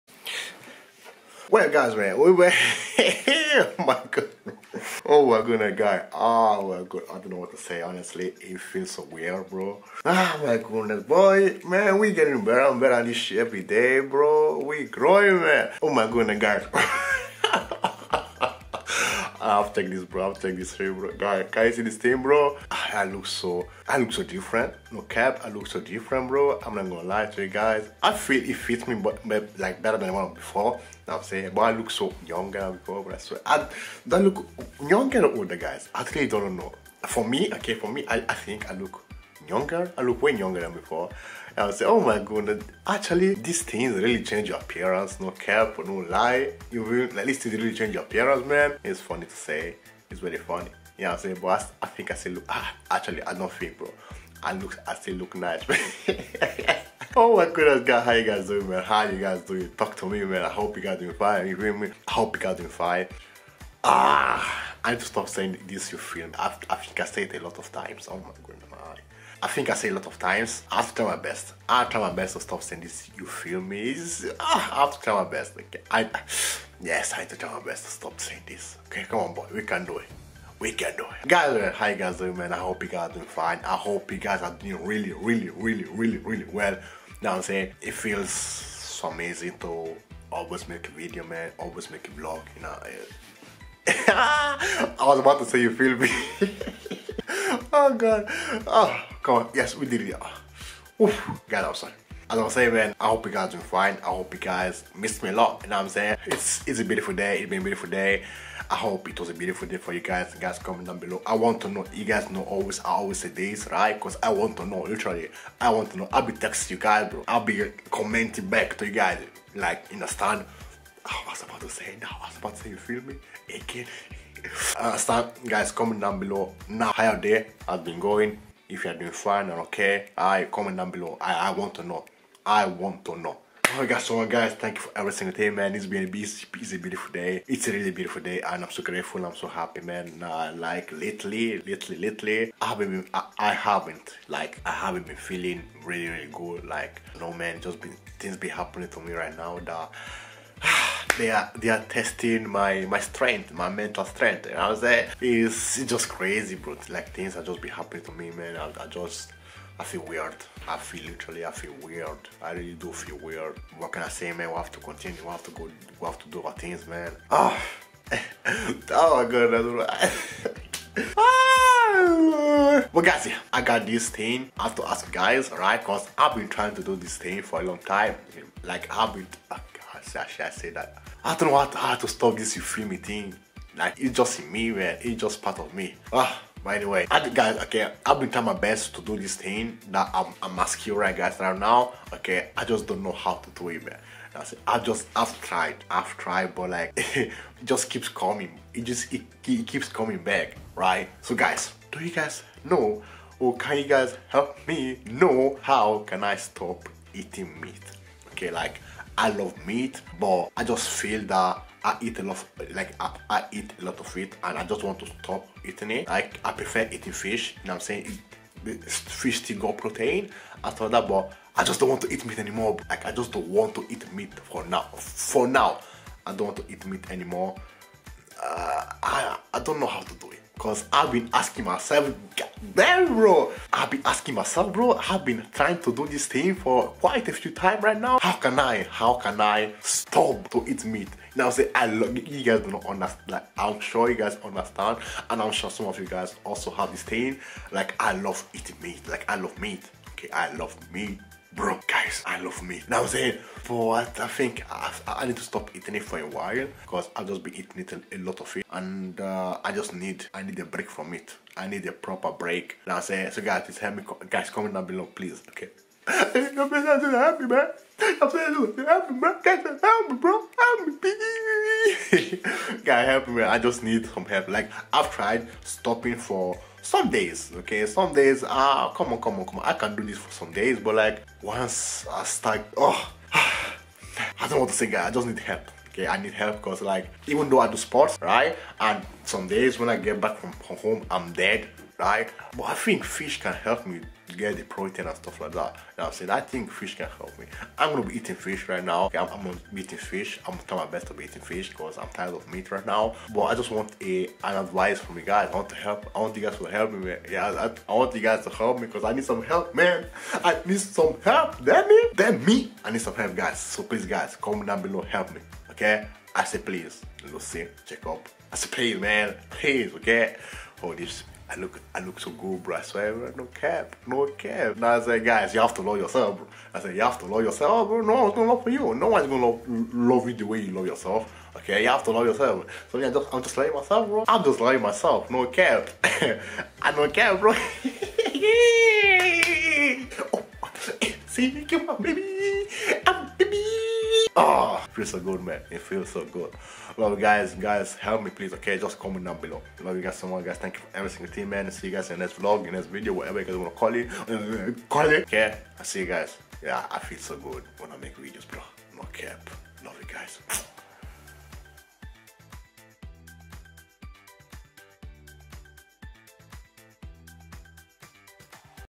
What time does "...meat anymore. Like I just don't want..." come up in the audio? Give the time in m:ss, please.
3:42.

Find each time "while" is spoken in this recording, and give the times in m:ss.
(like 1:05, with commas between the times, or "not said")
4:16.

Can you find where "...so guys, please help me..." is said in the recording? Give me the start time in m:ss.
4:23.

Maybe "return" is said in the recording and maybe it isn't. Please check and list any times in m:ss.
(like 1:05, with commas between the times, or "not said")
not said.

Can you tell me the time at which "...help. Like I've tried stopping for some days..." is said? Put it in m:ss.
4:34.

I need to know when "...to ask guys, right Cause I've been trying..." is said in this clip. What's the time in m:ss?
2:54.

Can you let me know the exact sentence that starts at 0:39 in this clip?
I look way younger than before.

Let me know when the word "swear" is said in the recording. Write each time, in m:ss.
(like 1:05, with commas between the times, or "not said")
0:33, 5:22.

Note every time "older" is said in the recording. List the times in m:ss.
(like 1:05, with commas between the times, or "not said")
0:35.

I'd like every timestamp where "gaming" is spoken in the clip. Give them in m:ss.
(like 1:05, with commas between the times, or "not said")
not said.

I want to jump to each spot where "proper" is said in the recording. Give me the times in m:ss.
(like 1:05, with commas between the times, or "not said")
4:21.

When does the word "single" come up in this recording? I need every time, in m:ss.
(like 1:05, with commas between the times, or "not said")
2:15, 5:51.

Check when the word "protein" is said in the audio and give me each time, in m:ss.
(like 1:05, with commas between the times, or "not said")
3:39, 4:54.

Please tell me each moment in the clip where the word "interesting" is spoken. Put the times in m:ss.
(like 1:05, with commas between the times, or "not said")
not said.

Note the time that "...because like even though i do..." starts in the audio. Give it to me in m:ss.
4:46.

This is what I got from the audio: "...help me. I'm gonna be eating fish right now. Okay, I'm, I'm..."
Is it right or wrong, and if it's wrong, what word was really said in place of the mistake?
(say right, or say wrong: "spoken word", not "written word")
right.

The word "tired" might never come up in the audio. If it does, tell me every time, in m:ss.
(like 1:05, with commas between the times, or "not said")
5:02.